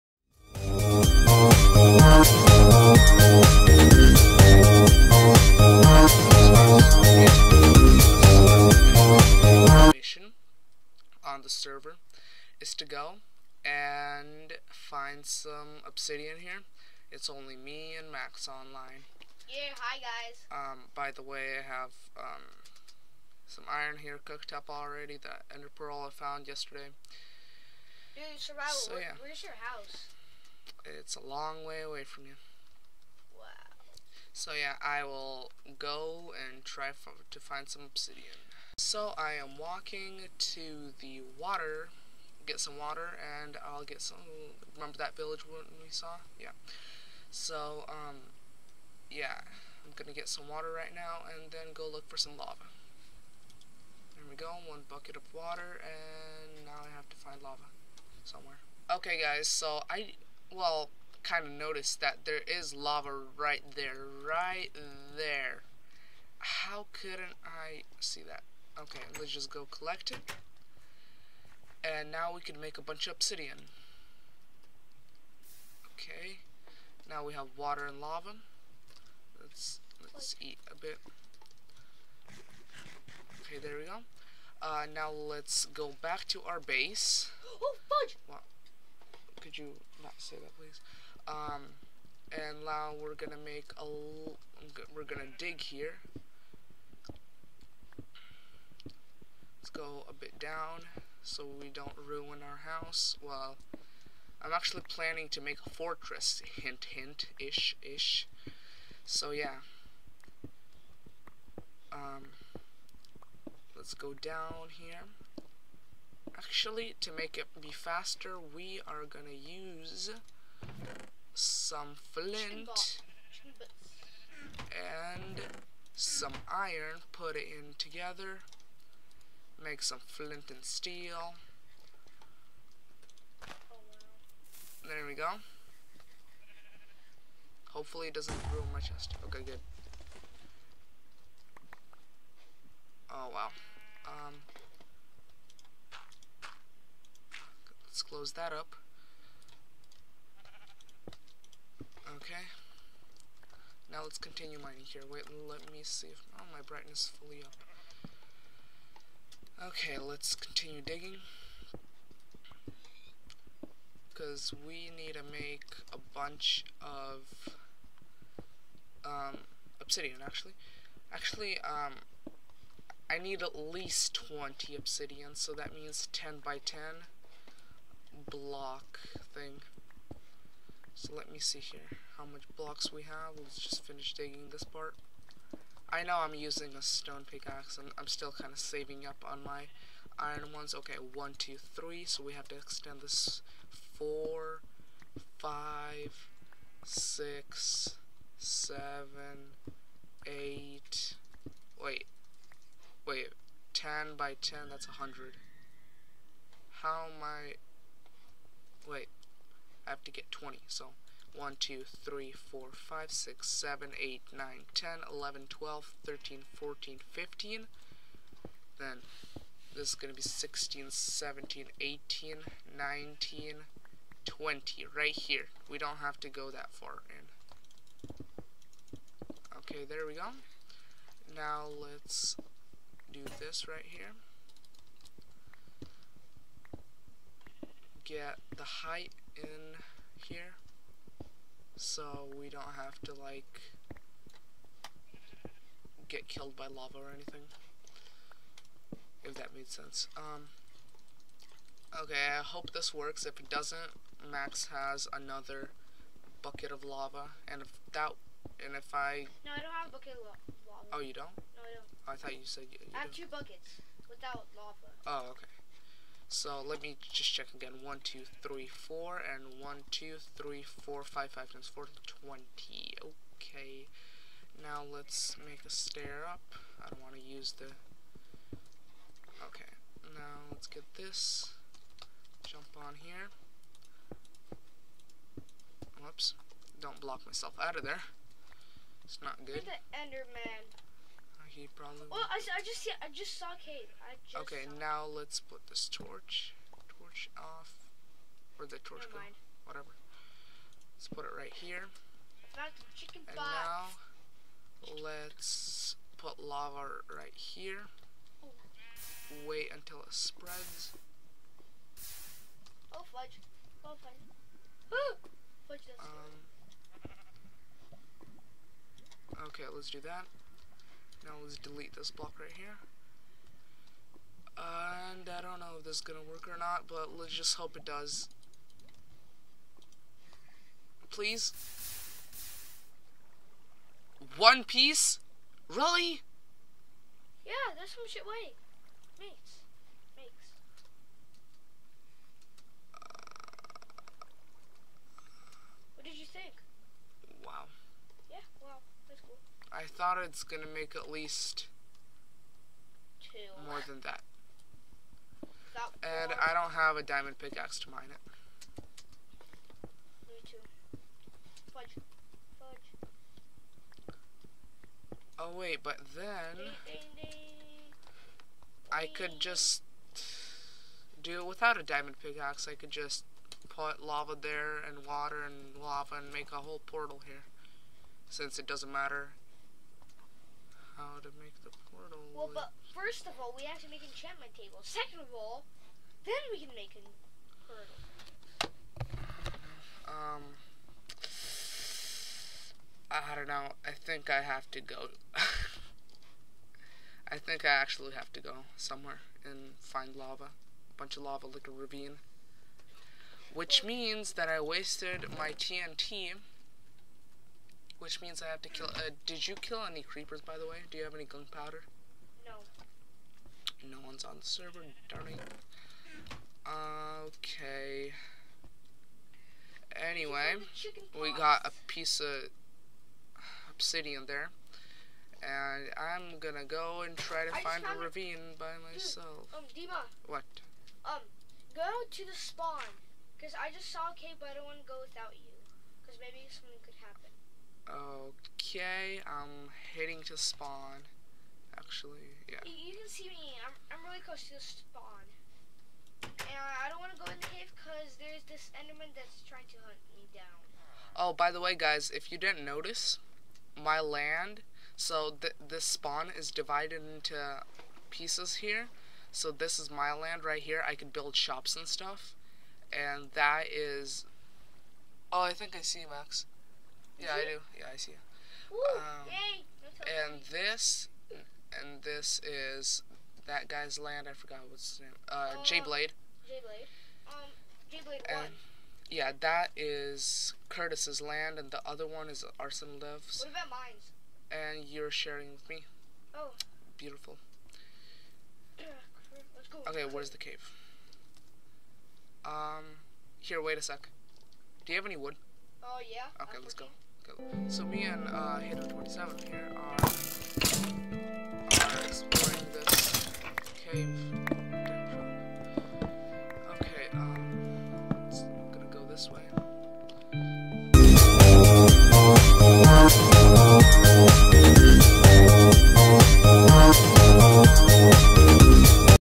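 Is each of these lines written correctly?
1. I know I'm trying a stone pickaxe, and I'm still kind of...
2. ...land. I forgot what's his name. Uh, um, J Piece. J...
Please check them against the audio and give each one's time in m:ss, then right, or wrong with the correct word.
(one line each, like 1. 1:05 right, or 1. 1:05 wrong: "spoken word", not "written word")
1. 3:05 wrong: "using", not "trying"
2. 7:53 wrong: "Blade", not "Piece".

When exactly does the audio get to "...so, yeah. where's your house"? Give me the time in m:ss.
0:28.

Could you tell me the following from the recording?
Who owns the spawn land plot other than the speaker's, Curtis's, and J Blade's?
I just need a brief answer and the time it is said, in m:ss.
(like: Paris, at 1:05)
Arsenal Dev, at 8:02.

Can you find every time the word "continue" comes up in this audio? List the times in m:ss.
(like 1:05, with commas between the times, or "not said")
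2:34, 2:40.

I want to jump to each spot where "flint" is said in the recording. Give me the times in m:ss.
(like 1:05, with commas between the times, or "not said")
2:02, 2:10.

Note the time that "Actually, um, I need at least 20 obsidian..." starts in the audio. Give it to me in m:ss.
2:51.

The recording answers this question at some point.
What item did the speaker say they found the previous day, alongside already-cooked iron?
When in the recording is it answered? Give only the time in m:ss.
0:25.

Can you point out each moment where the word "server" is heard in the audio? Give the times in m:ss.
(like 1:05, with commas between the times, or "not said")
0:11, 6:54.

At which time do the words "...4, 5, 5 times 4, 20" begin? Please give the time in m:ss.
4:30.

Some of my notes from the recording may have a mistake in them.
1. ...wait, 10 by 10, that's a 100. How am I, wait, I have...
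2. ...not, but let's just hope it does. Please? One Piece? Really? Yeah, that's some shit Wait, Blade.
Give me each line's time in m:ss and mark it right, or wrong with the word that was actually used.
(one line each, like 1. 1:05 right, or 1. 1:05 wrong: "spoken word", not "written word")
1. 3:23 right
2. 5:26 wrong: "Mates", not "Blade".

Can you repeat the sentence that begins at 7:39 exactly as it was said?
So this is my land right here.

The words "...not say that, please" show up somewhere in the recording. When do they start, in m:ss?
1:30.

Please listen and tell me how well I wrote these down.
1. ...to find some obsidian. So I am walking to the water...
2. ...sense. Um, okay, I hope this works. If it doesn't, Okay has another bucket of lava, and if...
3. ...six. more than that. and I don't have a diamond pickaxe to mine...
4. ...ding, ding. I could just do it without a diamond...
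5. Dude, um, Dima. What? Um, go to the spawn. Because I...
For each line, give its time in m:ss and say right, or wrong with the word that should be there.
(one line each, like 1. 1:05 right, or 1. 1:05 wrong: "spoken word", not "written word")
1. 0:37 right
2. 4:09 wrong: "Max", not "Okay"
3. 5:53 wrong: "two", not "six"
4. 6:07 right
5. 7:09 right.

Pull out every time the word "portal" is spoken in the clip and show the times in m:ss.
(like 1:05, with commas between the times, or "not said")
6:16, 6:21, 6:27.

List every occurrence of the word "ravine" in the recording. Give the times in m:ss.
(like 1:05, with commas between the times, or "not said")
6:41, 7:07.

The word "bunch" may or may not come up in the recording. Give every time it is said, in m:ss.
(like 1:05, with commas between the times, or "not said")
1:12, 2:46, 6:40.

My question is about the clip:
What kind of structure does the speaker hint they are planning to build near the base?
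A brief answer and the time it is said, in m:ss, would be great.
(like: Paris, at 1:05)
A fortress, at 1:45.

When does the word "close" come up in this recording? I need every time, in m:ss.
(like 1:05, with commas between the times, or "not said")
2:28, 7:24.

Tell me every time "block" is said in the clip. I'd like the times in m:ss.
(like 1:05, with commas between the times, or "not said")
2:58, 3:02, 4:47, 5:22.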